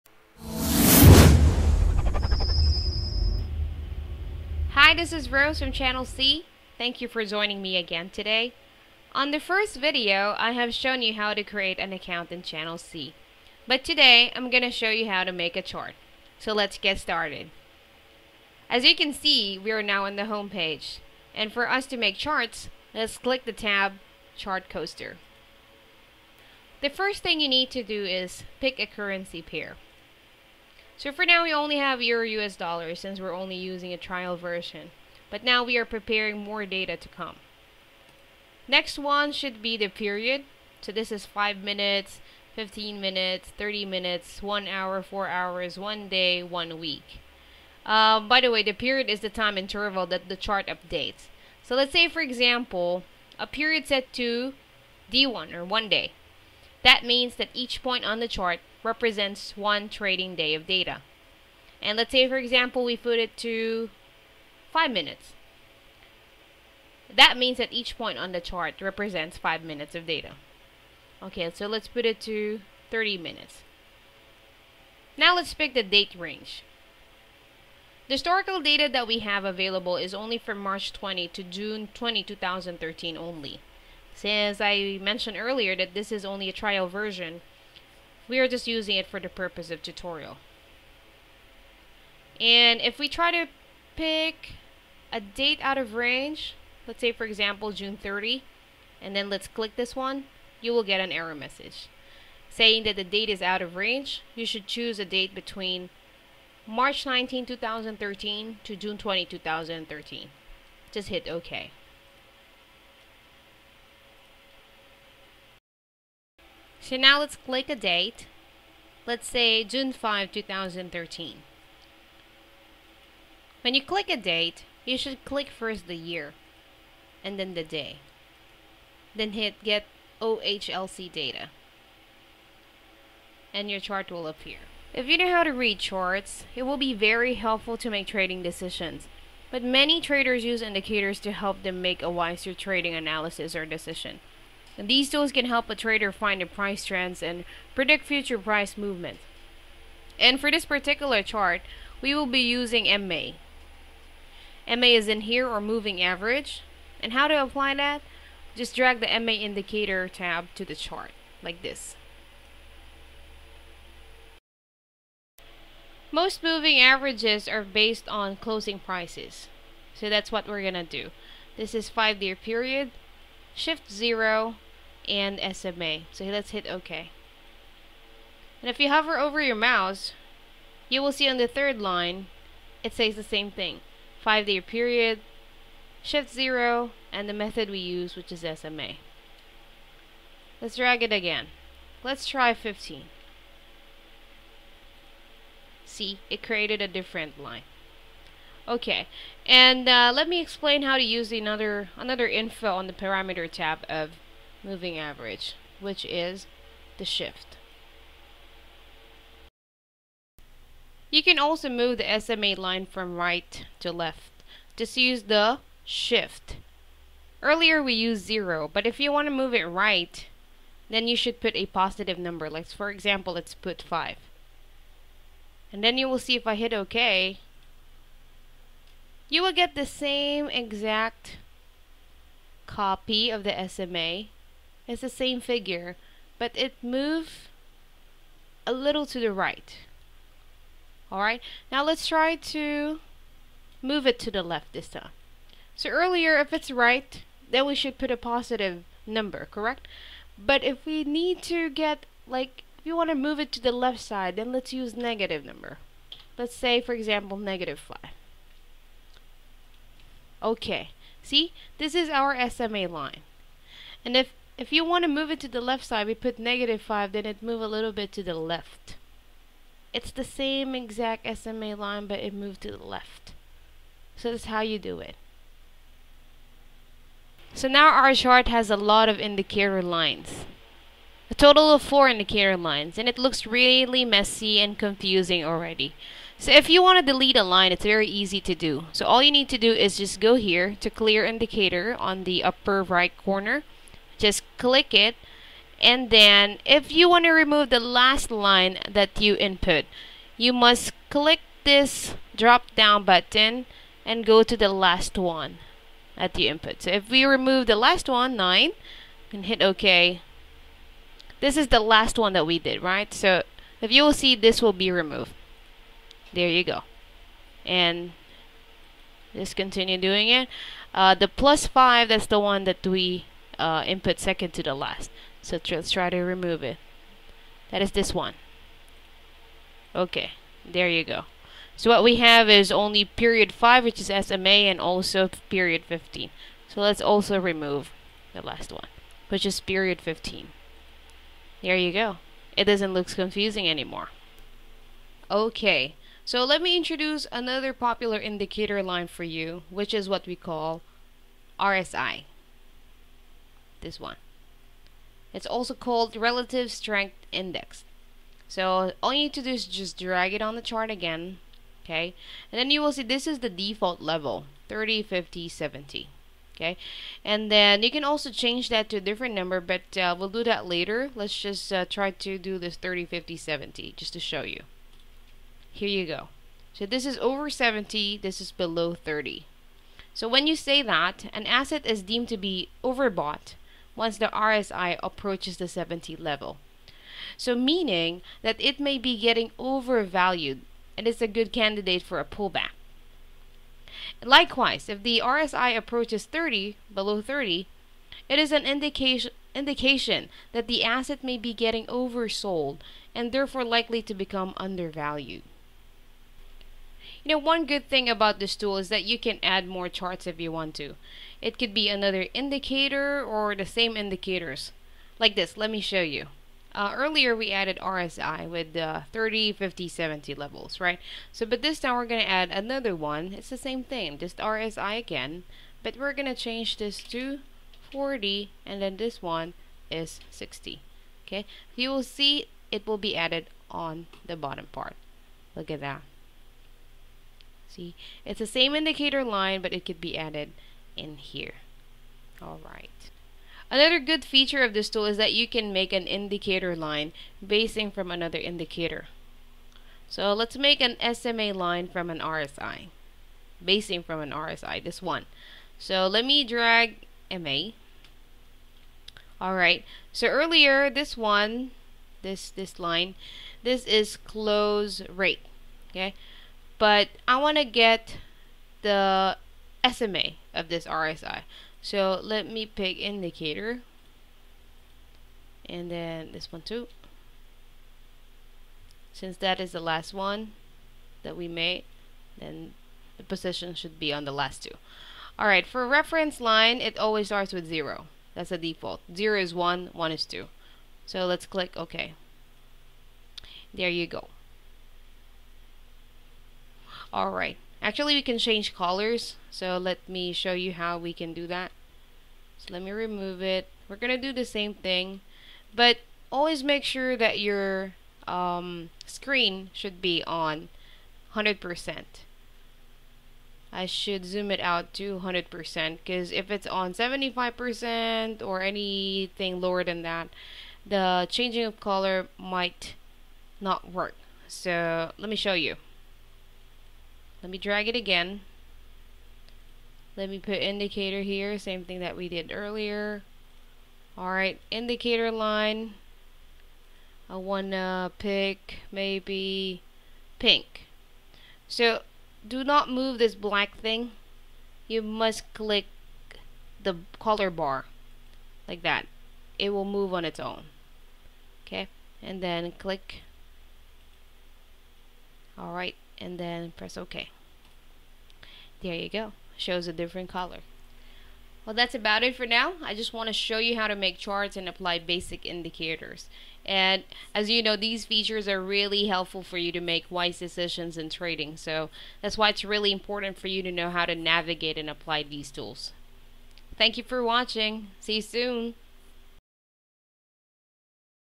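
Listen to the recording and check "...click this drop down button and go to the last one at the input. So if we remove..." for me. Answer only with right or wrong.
right.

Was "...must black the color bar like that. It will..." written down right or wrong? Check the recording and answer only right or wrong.
wrong.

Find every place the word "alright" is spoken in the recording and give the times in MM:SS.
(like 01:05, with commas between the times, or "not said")
04:01, 07:22, 07:39, 08:05, 08:17, 08:54, 09:15.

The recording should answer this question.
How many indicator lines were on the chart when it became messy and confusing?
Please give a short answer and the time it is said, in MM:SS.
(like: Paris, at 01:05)
4, at 04:41.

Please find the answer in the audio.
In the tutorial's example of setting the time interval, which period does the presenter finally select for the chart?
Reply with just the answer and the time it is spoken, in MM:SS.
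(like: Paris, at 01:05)
30 minutes, at 01:11.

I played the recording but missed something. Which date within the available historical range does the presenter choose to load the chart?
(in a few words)
June 5, 2013.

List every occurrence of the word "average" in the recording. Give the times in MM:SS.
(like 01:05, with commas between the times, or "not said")
02:36, 02:46, 03:24.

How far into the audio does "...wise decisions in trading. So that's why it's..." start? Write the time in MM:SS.
09:30.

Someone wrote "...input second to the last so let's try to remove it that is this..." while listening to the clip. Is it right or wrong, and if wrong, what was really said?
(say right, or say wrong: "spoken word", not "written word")
right.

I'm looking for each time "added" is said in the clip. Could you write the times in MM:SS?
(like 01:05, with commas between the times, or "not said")
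06:57, 07:13, 07:20.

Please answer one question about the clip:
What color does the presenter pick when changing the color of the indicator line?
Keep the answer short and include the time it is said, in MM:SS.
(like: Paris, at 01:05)
pink, at 09:00.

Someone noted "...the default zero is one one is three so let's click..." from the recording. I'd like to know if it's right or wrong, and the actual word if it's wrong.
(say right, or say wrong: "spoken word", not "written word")
wrong: "two", not "three".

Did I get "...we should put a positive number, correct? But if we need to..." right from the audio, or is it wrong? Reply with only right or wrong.
right.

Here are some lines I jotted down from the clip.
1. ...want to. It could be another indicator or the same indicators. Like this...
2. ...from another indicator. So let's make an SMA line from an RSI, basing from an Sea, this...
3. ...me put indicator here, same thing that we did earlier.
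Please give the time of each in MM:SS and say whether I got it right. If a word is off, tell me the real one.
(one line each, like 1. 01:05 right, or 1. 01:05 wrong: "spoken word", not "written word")
1. 06:50 right
2. 07:27 wrong: "RSI", not "Sea"
3. 08:50 right.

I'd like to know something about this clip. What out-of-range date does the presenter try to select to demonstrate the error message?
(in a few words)
June 30.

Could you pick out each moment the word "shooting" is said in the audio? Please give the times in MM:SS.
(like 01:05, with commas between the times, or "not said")
not said.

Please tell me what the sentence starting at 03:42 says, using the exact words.
Like for example, let's put five.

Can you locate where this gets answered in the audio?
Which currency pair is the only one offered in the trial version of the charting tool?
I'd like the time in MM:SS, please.
00:32.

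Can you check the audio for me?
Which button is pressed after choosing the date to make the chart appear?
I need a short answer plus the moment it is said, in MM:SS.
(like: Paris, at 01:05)
get OHLC data, at 02:09.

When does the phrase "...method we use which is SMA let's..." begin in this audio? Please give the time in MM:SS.
03:07.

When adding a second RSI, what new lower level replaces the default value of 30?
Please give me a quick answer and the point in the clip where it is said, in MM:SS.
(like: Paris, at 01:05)
40, at 07:06.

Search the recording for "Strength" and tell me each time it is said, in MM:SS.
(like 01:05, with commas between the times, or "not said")
05:56.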